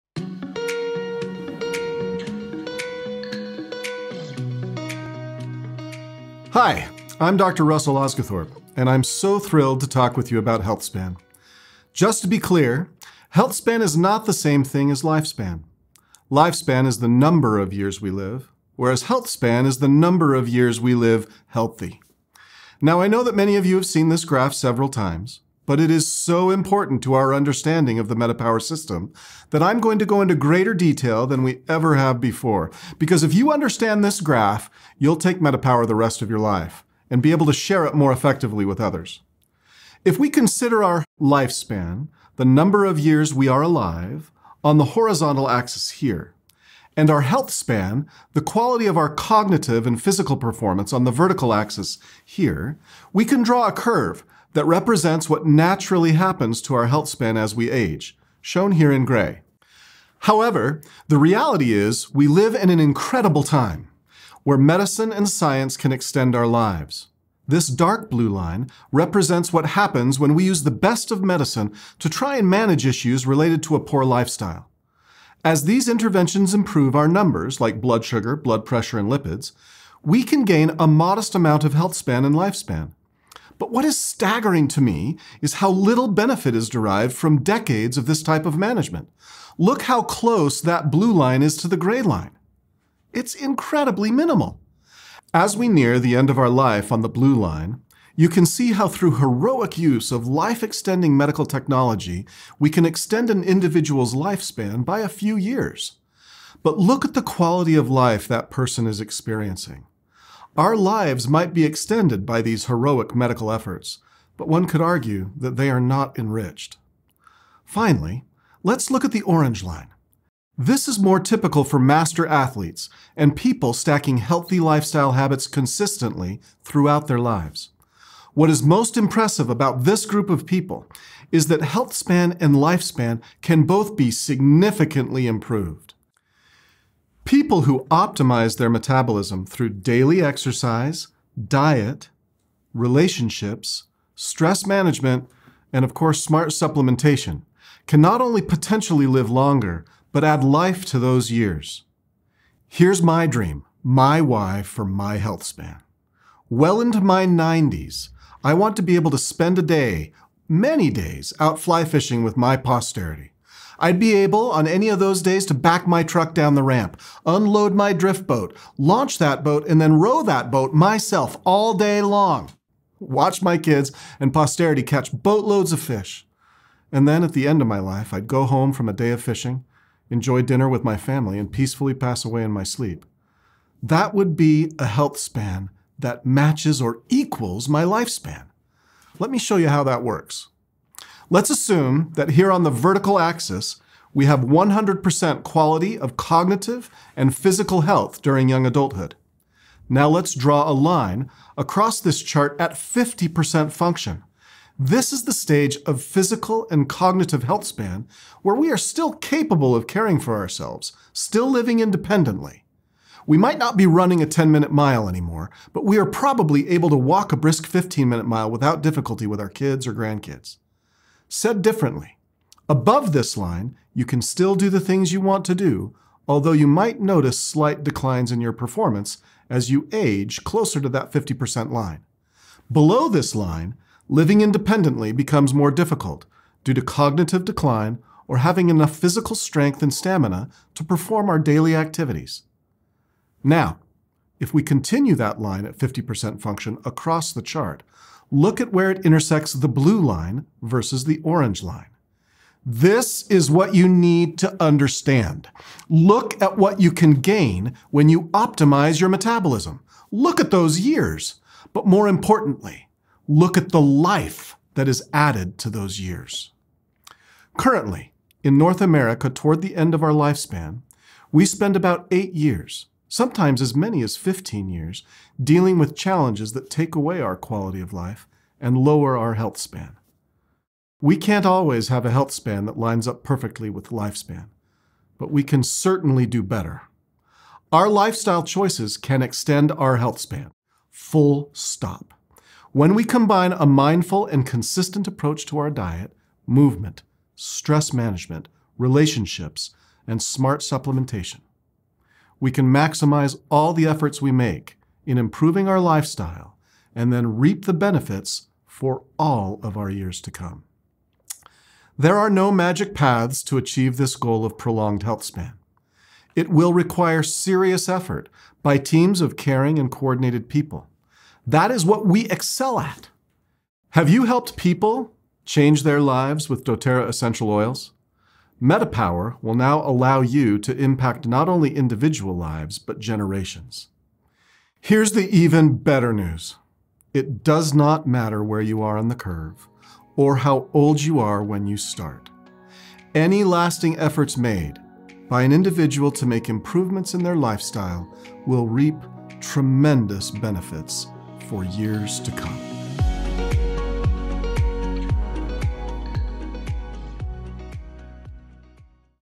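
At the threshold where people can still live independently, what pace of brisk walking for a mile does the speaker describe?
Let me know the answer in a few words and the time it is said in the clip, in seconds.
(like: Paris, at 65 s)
15 minute mile, at 217 s.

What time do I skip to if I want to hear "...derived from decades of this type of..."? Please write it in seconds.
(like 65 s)
86 s.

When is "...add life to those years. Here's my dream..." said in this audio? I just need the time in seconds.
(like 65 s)
150 s.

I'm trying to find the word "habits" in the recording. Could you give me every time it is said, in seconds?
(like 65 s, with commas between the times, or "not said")
125 s.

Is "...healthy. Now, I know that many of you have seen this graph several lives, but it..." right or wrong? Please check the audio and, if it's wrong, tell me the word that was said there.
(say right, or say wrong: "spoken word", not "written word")
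wrong: "times", not "lives".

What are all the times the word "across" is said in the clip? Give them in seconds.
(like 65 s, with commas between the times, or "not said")
201 s, 246 s.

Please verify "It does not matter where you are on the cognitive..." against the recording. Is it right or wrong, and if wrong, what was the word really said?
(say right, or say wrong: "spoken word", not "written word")
wrong: "curve", not "cognitive".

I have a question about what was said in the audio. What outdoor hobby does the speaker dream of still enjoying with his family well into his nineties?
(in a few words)
fly fishing.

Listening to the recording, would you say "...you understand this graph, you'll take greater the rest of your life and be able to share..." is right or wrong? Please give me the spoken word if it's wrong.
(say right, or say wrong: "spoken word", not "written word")
wrong: "metapower", not "greater".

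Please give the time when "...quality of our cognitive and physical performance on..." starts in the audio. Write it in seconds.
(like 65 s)
48 s.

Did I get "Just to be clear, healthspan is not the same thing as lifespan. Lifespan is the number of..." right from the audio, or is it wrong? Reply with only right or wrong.
right.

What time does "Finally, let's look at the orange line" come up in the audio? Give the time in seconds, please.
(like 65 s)
117 s.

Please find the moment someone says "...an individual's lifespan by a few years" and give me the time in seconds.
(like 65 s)
103 s.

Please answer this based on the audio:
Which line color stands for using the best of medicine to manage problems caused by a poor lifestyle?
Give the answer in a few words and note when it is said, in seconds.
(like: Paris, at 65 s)
dark blue, at 67 s.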